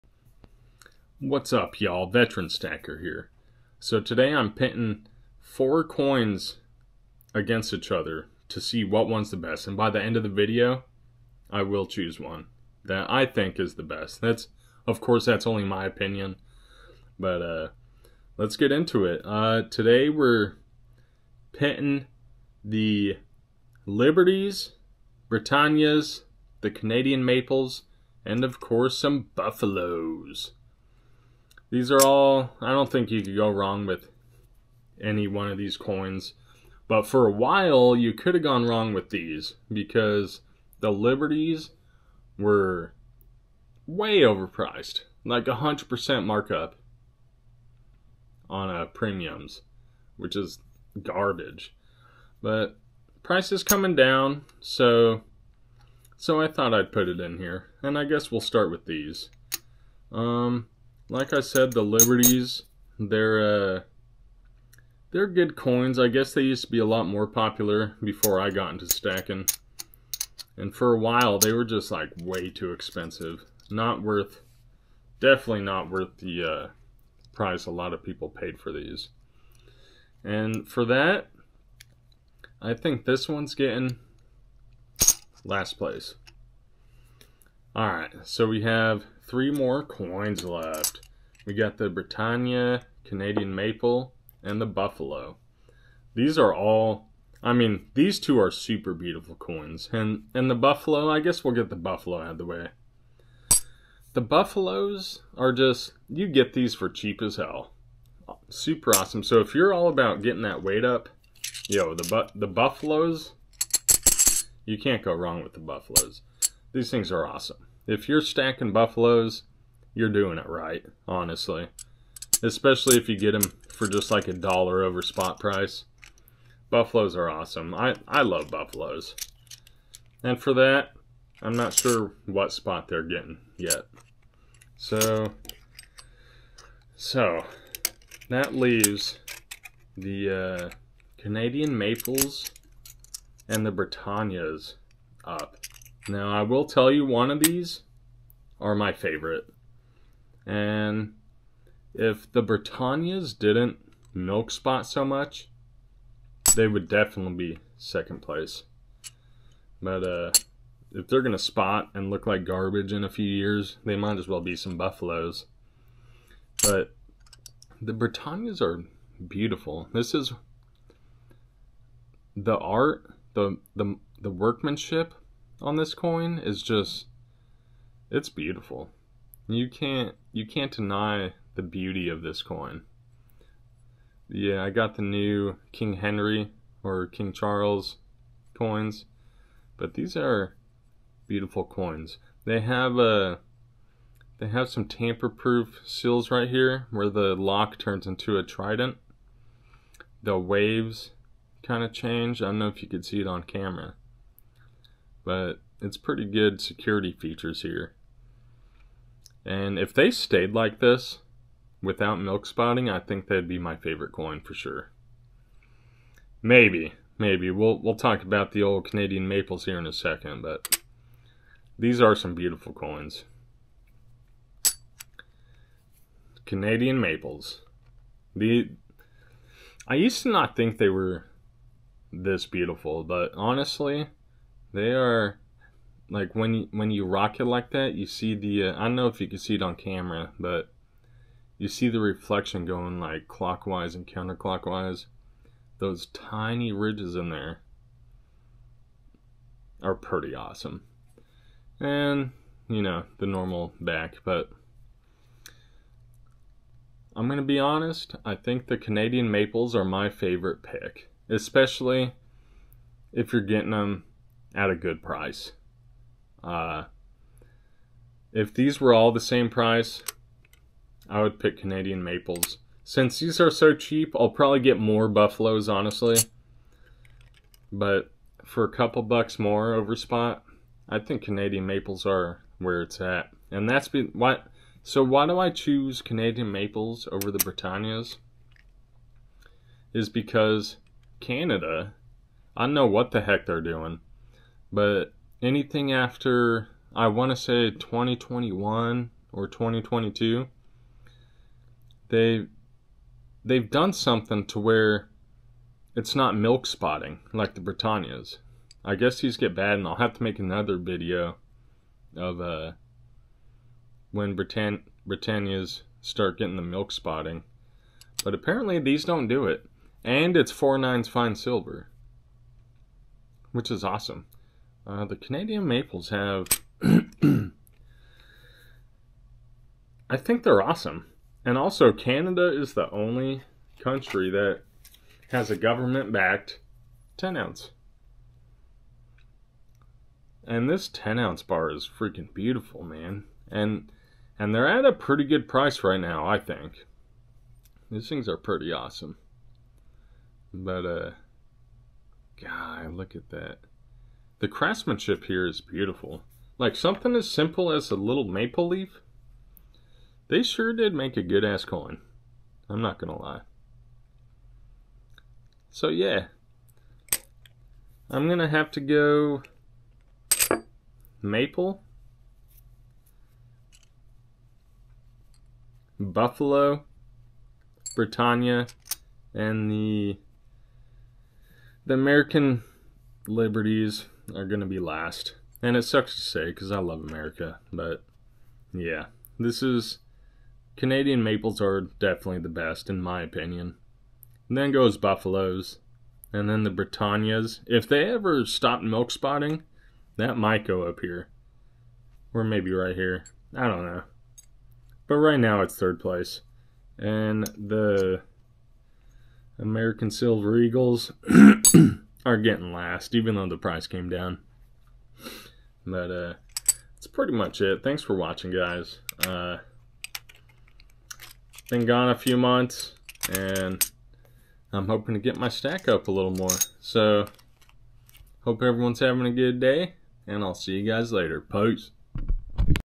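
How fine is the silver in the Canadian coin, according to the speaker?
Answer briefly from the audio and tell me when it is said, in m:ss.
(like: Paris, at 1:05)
four nines, at 5:20.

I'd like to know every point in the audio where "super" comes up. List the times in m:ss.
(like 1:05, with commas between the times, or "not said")
1:38, 1:48.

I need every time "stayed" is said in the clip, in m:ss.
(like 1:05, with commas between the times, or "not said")
3:30.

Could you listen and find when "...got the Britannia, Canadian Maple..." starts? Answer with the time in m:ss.
1:31.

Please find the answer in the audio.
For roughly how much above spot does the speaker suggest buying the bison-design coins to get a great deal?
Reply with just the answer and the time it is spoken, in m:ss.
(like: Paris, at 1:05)
a dollar, at 2:04.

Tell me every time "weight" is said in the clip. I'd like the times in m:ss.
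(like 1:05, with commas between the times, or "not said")
1:50.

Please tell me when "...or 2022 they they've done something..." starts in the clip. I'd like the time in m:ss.
4:59.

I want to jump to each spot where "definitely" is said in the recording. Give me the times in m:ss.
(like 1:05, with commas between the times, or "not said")
1:15, 2:36, 6:31.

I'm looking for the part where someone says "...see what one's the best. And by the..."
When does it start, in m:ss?
0:08.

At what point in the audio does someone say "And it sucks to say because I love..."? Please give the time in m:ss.
6:25.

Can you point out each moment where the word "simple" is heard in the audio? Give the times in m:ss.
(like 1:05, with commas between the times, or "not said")
5:57.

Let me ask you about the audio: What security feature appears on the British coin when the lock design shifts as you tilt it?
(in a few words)
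a trident.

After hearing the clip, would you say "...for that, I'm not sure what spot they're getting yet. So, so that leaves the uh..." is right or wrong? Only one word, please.
right.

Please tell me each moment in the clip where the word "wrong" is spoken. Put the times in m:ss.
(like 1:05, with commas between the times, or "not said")
0:33, 0:38, 1:55.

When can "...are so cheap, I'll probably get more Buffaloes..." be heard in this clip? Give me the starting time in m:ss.
4:33.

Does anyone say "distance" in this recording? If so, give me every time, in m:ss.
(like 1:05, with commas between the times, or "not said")
not said.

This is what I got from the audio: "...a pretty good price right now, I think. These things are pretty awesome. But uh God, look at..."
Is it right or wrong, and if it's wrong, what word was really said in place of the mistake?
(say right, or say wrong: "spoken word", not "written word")
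right.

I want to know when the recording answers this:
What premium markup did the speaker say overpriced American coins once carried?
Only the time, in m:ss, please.
0:45.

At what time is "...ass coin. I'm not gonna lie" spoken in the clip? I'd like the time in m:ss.
6:01.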